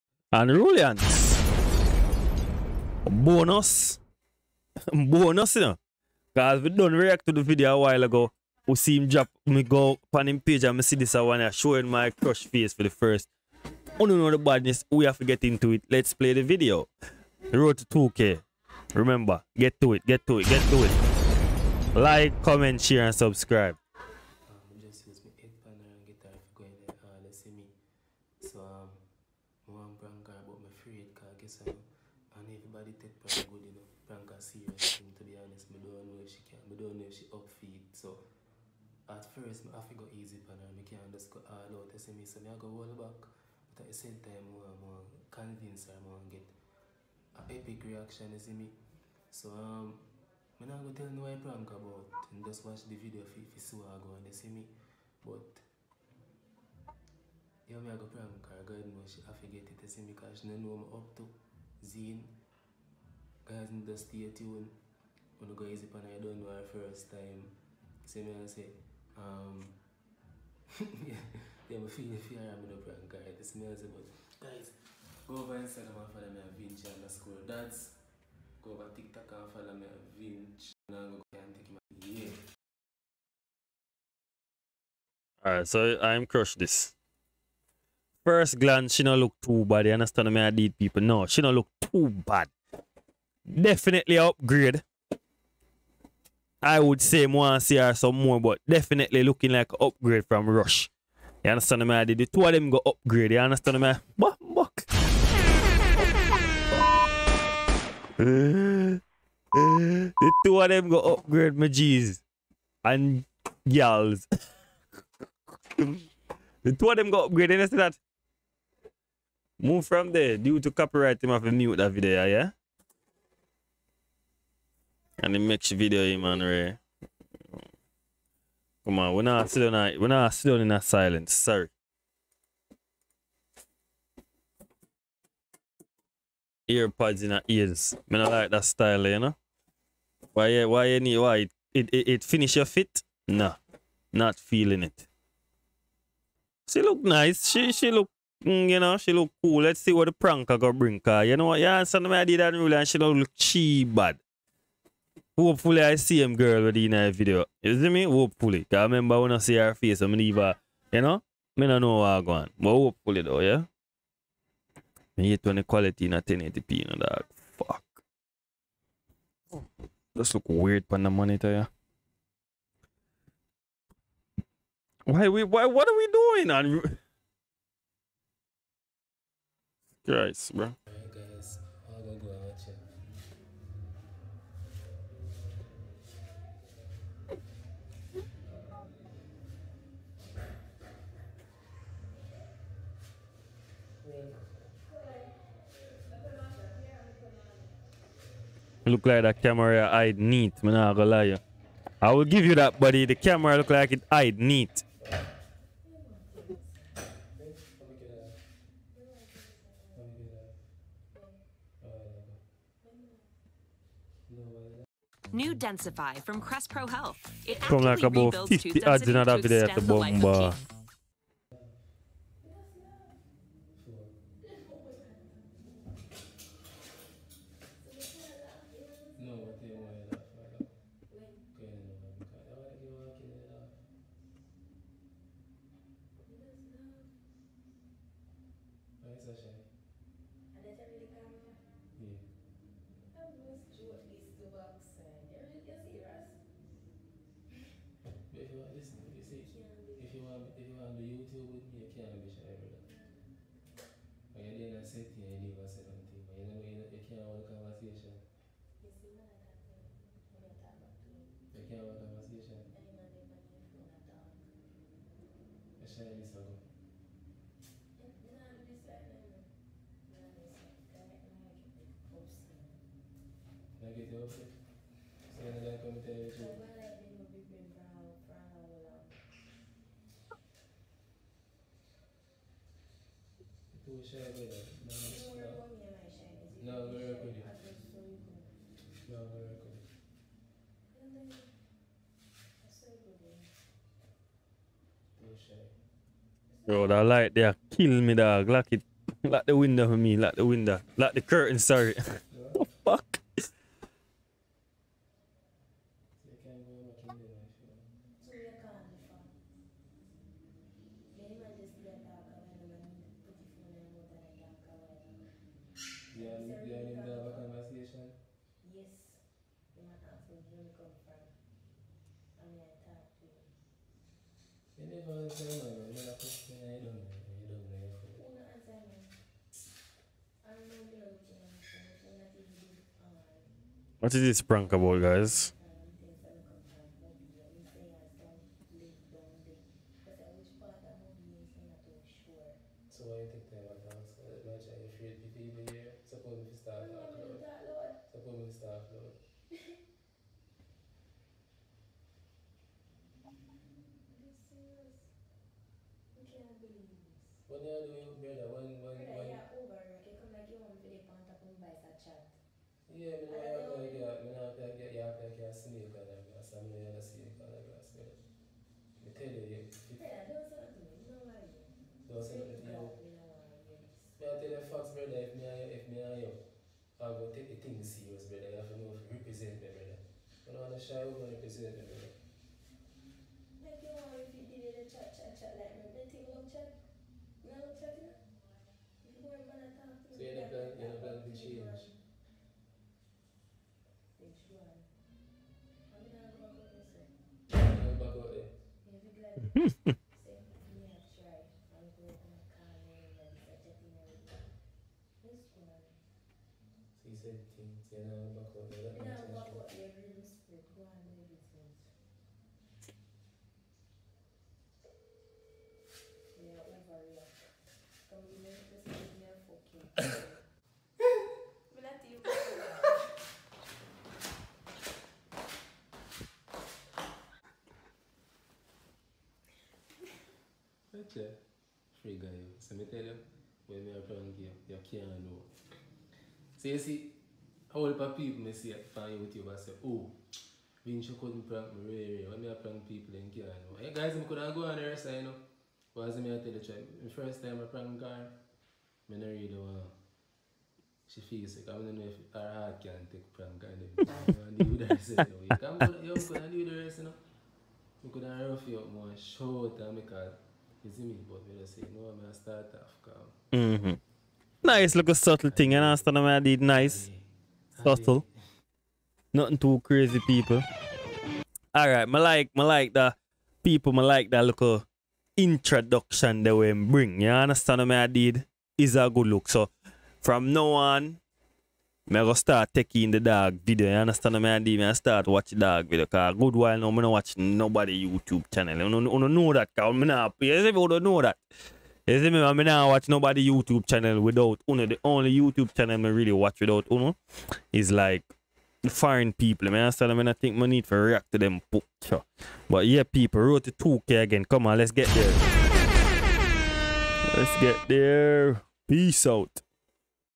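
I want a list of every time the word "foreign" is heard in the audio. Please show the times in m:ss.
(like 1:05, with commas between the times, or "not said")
8:18.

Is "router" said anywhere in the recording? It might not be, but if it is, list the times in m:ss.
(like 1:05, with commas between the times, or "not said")
not said.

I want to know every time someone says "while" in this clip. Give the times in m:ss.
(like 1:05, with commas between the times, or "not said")
0:07, 8:06.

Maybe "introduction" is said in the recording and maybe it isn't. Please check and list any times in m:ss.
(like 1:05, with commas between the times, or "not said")
7:55.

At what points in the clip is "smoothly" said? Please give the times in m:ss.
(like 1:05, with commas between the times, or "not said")
not said.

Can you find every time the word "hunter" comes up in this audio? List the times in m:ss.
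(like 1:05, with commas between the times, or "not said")
not said.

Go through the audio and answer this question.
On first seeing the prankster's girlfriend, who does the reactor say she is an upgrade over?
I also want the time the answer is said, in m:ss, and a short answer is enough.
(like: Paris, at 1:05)
Rush, at 1:40.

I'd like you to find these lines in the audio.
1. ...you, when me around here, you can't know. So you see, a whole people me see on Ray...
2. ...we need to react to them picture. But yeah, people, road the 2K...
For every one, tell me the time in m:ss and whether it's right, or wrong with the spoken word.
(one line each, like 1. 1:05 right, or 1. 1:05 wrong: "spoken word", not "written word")
1. 7:13 wrong: "YouTube", not "Ray"
2. 8:20 right.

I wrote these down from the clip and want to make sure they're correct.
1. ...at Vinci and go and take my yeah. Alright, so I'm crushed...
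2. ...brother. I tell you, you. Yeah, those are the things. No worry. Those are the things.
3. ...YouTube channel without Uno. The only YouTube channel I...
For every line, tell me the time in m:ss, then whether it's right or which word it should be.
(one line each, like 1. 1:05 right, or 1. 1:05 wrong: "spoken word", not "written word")
1. 1:19 right
2. 6:07 right
3. 8:13 right.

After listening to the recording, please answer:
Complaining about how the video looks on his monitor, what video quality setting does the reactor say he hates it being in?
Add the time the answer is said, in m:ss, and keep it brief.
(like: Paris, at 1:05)
1080p, at 2:46.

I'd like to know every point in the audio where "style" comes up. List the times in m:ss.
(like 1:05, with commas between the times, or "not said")
2:18.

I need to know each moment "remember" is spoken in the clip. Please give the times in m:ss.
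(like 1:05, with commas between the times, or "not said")
0:18, 2:38.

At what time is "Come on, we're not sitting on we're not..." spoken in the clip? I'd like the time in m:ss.
2:08.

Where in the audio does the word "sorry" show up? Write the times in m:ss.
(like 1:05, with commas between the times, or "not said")
2:11, 5:01.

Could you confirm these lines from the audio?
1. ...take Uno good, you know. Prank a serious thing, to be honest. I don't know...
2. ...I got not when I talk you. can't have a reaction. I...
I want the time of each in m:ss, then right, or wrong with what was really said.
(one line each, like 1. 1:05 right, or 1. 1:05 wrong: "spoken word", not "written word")
1. 0:33 wrong: "Prank", not "Uno"
2. 4:19 wrong: "conversation", not "reaction".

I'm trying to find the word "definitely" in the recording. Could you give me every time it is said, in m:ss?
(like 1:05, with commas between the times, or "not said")
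1:33, 1:38.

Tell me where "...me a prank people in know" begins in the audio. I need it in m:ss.
7:22.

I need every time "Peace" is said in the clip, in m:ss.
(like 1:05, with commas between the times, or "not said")
8:28.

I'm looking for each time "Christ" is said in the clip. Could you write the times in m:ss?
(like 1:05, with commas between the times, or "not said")
3:00.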